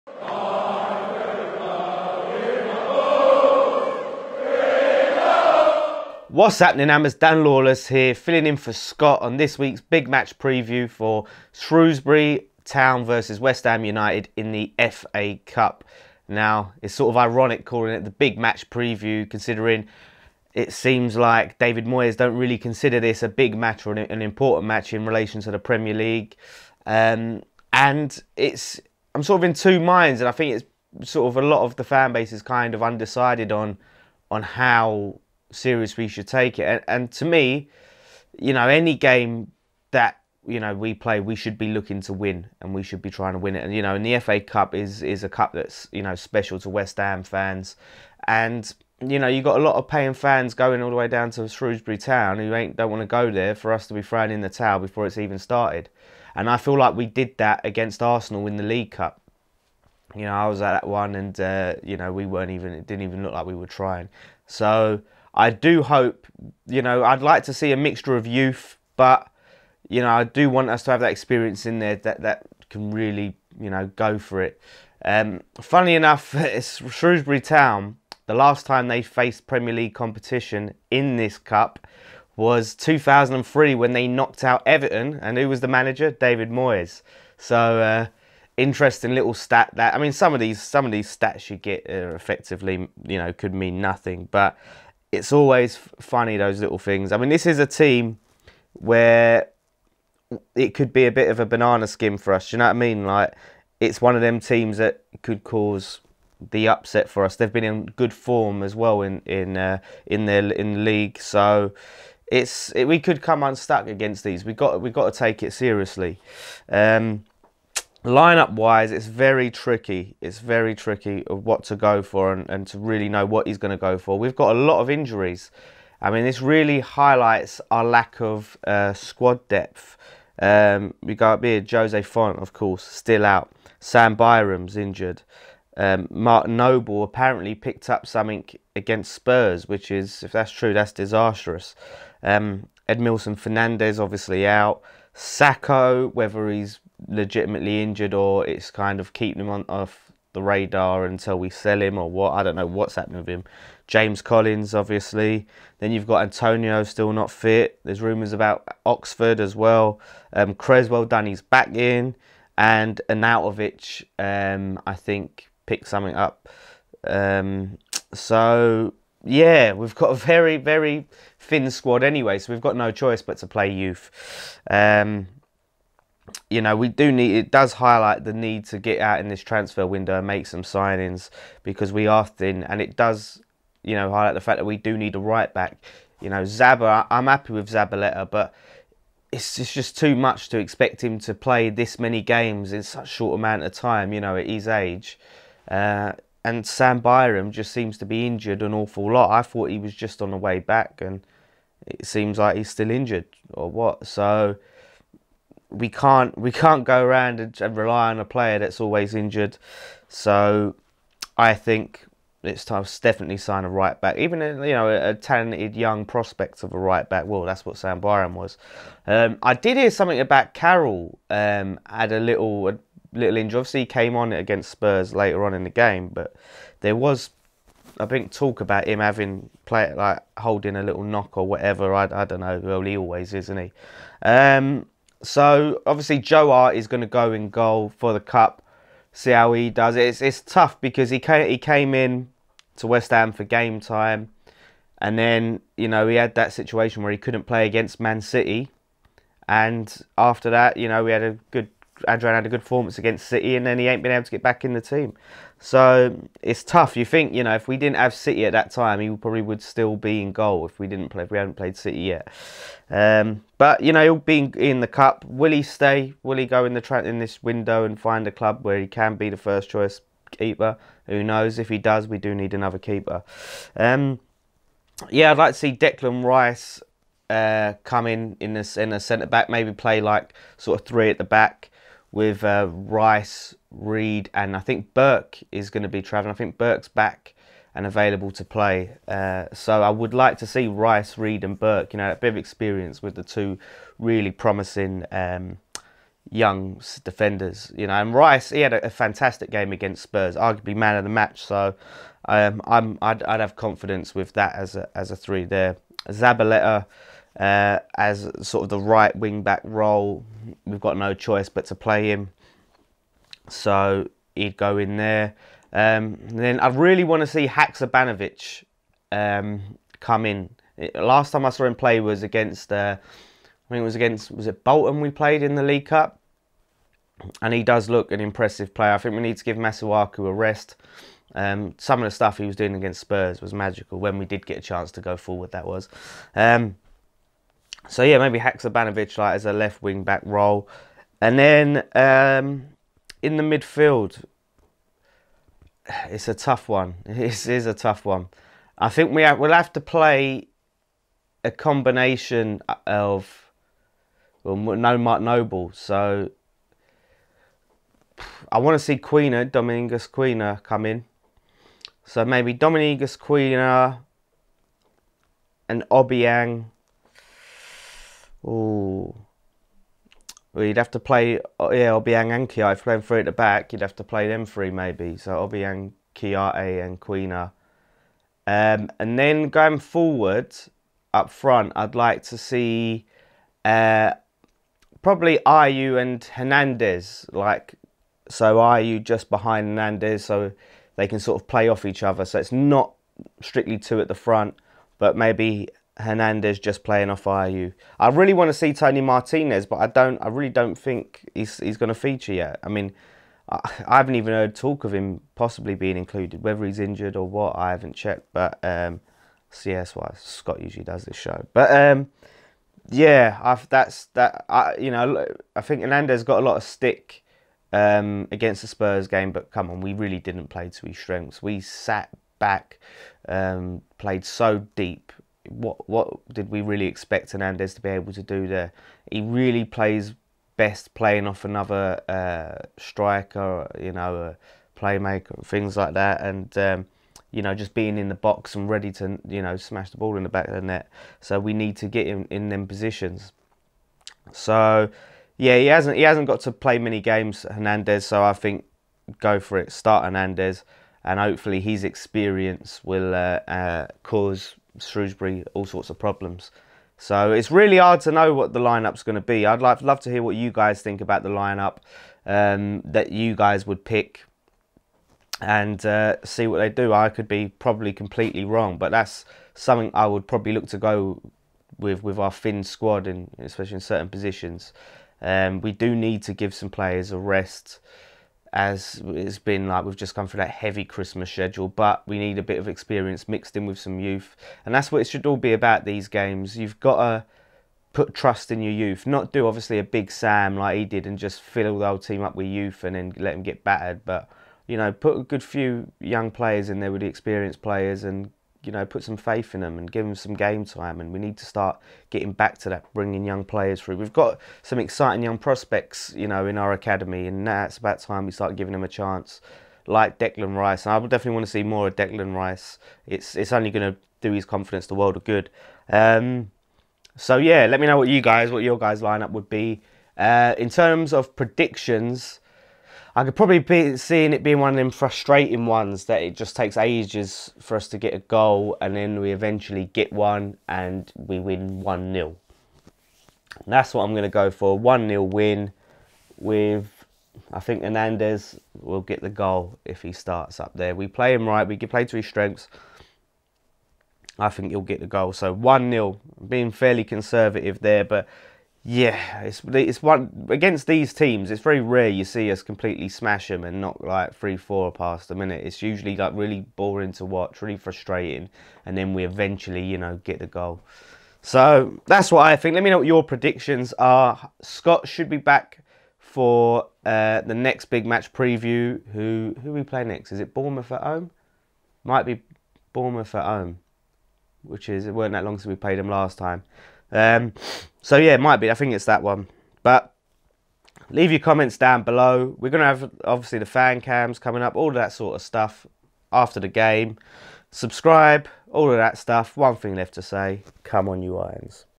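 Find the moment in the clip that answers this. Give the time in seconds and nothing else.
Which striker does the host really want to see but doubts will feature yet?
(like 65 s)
398 s.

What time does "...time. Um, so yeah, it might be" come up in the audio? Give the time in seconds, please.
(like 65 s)
576 s.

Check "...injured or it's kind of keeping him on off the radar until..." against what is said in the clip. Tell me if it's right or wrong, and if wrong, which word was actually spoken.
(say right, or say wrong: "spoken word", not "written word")
right.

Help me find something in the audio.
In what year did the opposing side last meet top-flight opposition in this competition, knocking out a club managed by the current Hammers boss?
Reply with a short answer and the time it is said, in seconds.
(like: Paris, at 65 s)
2003, at 82 s.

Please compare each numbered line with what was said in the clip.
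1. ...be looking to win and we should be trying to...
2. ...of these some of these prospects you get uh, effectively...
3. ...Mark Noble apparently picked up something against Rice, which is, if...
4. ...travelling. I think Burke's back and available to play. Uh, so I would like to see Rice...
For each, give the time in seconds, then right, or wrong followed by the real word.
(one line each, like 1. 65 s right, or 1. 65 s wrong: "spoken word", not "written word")
1. 41 s right
2. 90 s wrong: "stats", not "prospects"
3. 136 s wrong: "Spurs", not "Rice"
4. 286 s right.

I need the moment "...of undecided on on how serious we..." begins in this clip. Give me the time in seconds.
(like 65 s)
32 s.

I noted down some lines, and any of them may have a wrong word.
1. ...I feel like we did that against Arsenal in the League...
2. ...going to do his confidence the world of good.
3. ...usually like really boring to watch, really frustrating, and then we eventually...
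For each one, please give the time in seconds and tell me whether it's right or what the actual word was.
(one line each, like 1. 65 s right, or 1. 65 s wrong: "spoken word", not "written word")
1. 56 s right
2. 513 s right
3. 555 s right.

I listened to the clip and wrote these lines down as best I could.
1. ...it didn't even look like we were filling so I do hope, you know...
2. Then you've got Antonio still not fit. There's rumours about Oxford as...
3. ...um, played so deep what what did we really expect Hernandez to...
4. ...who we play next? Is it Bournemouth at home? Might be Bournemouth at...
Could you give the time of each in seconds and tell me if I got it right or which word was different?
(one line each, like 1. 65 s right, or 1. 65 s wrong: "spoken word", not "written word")
1. 62 s wrong: "trying", not "filling"
2. 155 s right
3. 423 s right
4. 569 s right.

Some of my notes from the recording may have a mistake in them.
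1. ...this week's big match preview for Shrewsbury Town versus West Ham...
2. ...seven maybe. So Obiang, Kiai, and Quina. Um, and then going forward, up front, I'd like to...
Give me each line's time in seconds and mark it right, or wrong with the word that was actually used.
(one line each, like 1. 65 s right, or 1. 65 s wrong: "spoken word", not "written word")
1. 9 s right
2. 374 s wrong: "three", not "seven".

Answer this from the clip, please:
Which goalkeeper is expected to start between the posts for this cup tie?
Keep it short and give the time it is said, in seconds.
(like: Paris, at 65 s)
Joe Hart, at 236 s.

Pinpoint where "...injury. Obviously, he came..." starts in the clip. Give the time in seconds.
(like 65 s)
223 s.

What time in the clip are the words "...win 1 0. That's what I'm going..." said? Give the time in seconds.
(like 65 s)
531 s.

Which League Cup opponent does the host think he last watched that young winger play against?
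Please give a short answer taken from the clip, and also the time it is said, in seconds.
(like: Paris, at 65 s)
Bolton, at 324 s.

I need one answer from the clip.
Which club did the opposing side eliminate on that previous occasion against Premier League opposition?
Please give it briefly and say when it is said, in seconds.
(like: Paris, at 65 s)
Everton, at 84 s.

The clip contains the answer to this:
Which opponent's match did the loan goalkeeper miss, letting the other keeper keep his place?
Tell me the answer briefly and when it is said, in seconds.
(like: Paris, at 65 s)
Man City, at 247 s.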